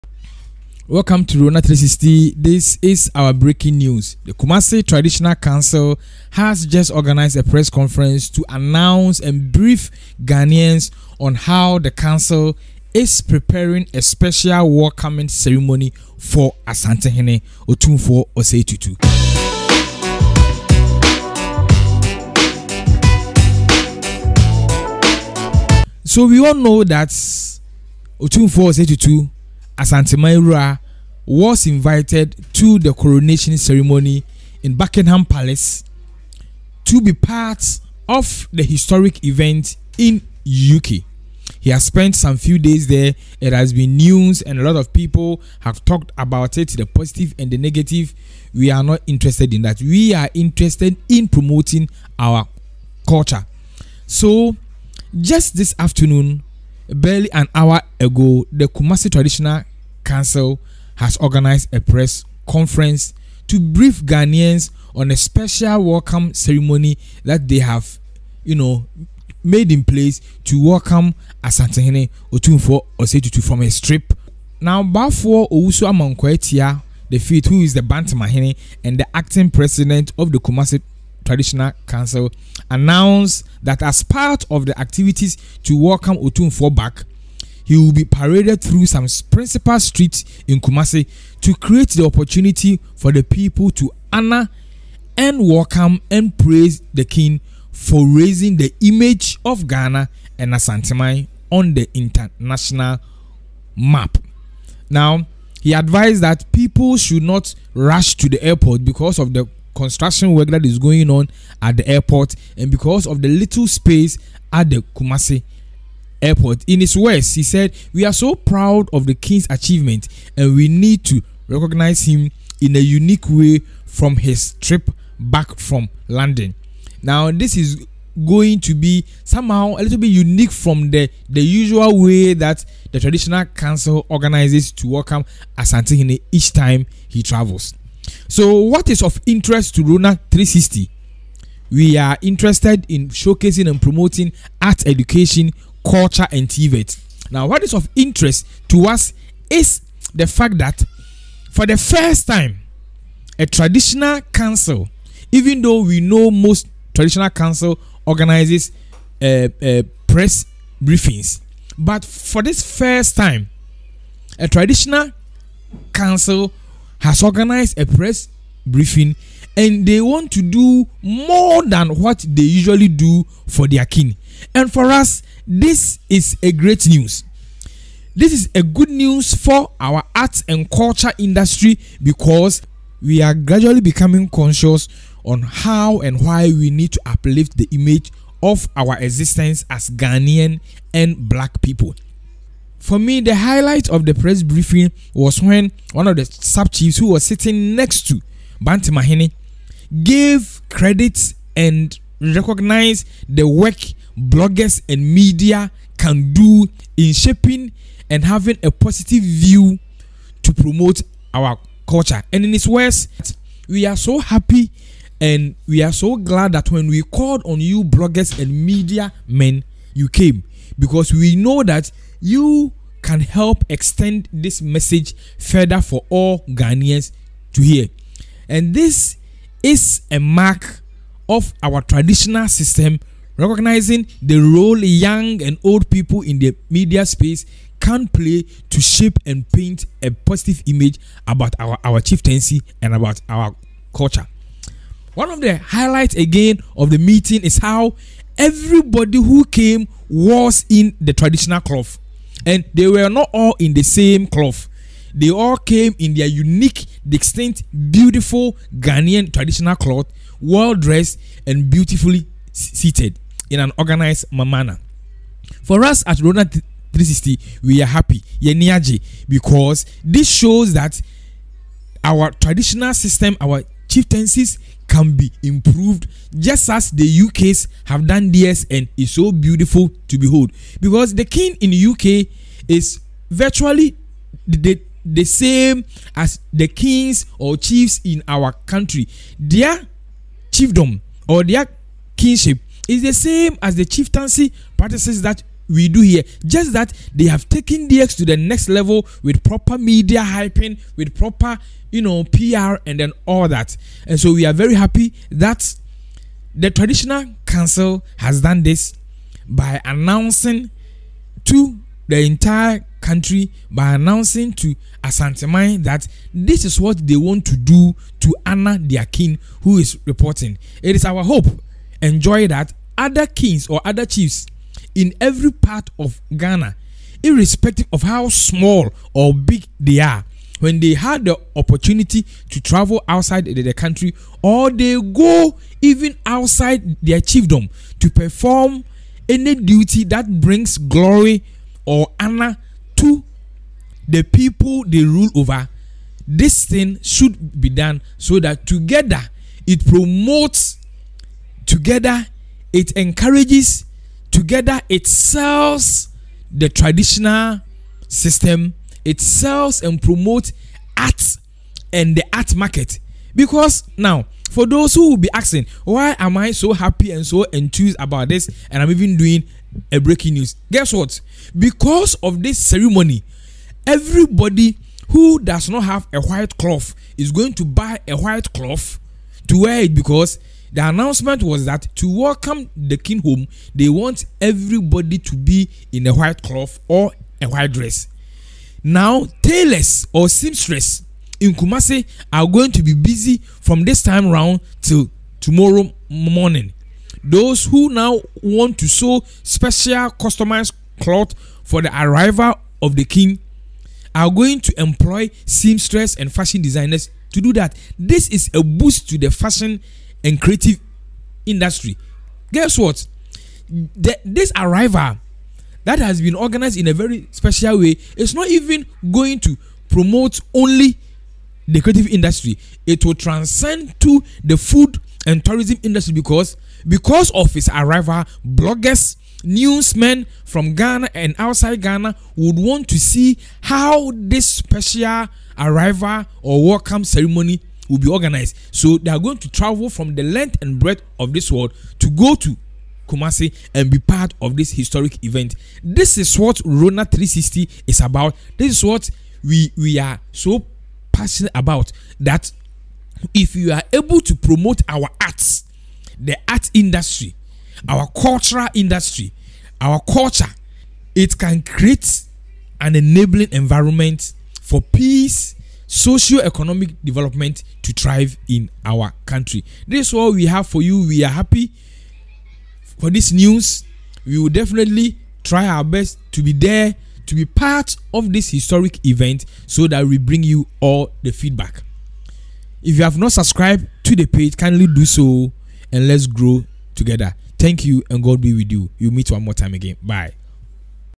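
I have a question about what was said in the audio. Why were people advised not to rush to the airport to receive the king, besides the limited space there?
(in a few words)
construction work.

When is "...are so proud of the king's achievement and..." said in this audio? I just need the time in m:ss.
1:58.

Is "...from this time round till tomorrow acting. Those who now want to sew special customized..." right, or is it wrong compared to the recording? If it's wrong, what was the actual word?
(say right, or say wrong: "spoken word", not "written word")
wrong: "morning", not "acting".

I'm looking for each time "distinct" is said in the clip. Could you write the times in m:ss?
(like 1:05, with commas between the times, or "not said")
4:17.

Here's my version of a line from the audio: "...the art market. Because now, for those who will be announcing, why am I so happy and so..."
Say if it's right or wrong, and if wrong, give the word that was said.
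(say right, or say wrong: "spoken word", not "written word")
wrong: "asking", not "announcing".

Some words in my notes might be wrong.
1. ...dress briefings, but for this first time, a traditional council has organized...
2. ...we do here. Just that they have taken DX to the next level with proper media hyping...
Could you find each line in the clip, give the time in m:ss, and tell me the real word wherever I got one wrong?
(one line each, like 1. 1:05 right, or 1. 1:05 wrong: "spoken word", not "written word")
1. 2:40 wrong: "press", not "dress"
2. 4:55 right.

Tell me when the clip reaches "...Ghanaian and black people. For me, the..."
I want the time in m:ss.
3:09.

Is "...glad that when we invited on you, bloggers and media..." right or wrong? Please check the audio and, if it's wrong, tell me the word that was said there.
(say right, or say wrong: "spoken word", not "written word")
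wrong: "called", not "invited".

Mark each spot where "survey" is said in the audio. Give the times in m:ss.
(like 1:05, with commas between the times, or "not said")
not said.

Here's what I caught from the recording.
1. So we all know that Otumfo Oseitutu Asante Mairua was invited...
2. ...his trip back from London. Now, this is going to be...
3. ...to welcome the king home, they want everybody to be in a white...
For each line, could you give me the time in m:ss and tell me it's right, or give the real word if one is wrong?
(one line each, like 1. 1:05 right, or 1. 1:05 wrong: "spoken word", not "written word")
1. 0:26 right
2. 2:04 right
3. 6:21 right.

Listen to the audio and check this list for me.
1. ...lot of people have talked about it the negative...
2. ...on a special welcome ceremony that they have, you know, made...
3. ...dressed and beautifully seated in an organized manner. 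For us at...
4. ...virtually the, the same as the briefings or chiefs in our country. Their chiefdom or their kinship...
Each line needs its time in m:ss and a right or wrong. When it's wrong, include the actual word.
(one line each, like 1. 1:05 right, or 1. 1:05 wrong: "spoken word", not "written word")
1. 0:44 wrong: "positive", not "negative"
2. 1:04 right
3. 4:20 right
4. 4:43 wrong: "kings", not "briefings".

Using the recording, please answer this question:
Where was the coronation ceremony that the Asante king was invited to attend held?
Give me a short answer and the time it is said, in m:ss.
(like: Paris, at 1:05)
Buckingham Palace, at 0:34.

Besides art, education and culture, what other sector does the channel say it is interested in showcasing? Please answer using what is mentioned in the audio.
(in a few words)
TVET.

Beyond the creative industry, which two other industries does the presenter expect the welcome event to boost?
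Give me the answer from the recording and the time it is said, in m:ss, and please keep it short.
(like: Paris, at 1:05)
food and tourism, at 7:04.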